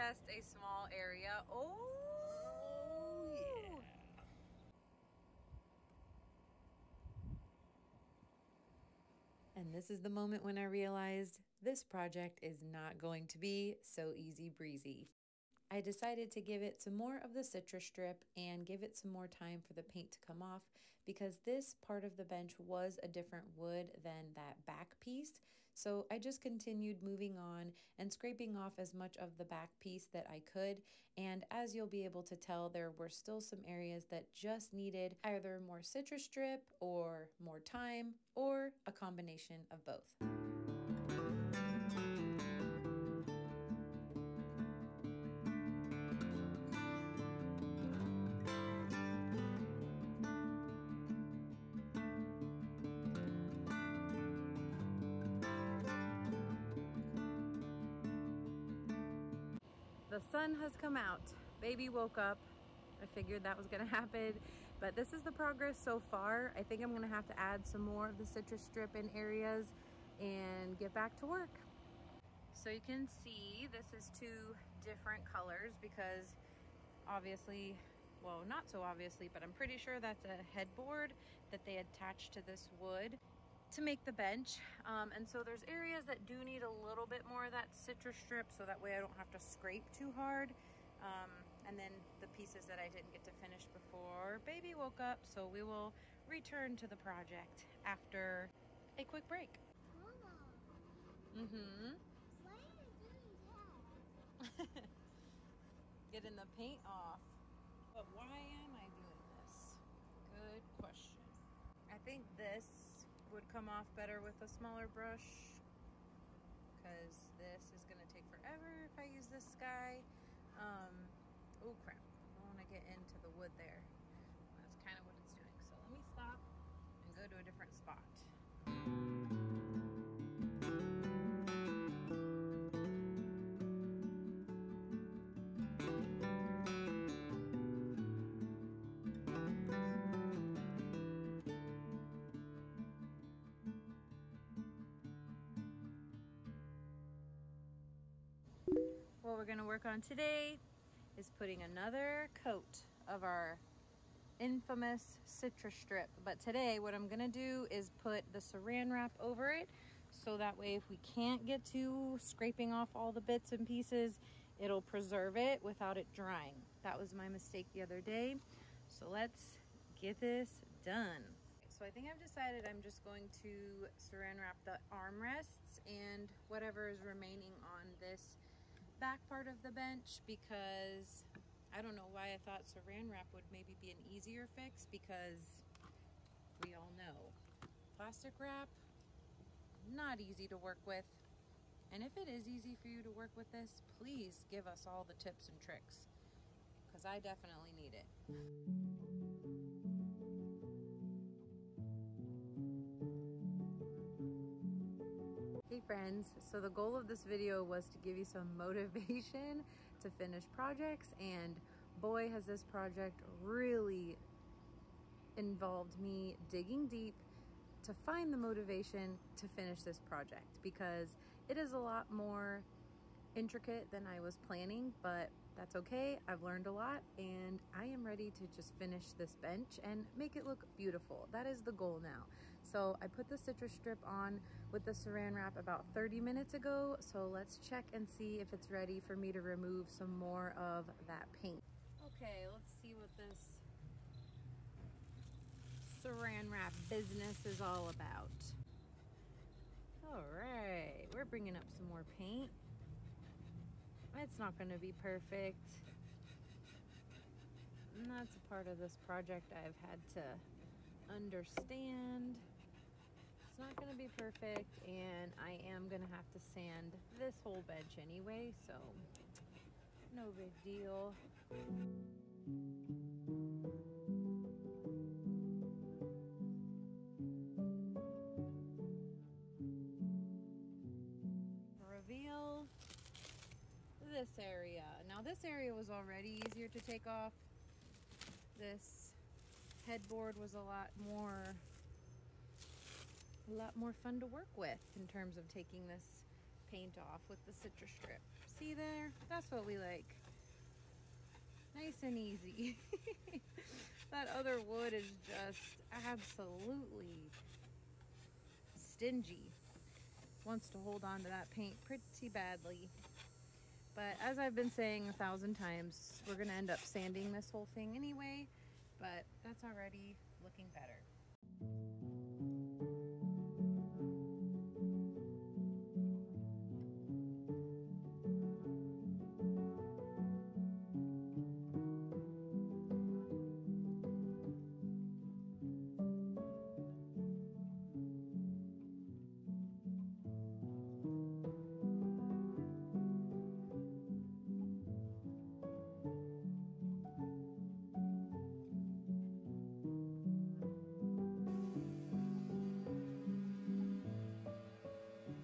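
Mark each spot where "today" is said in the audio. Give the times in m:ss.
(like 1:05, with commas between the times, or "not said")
2:29, 2:36.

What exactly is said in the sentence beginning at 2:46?
That was my mistake the other day.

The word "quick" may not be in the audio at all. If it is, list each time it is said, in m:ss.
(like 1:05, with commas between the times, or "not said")
1:39.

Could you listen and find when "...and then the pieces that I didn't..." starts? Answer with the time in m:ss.
1:31.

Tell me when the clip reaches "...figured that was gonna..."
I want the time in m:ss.
1:03.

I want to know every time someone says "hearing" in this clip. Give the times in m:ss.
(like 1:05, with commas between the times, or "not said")
not said.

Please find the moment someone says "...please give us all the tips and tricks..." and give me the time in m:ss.
3:13.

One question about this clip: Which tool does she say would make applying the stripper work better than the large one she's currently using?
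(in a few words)
smaller brush.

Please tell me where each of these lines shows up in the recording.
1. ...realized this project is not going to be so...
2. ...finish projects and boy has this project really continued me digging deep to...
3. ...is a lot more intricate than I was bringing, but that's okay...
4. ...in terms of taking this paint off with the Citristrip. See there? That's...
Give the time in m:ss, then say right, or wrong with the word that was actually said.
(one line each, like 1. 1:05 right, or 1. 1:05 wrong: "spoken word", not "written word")
1. 0:10 right
2. 3:30 wrong: "involved", not "continued"
3. 3:41 wrong: "planning", not "bringing"
4. 4:54 right.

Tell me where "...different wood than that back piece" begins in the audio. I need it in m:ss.
0:23.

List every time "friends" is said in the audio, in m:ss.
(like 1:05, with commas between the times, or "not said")
3:25.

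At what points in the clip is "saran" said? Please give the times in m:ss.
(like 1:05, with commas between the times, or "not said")
2:38, 2:53, 3:02, 3:54, 4:06.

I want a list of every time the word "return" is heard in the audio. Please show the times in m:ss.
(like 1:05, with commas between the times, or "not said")
1:36.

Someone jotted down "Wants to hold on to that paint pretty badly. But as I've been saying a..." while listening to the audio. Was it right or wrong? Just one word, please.
right.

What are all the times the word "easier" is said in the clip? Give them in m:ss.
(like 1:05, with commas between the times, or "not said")
3:04, 4:46.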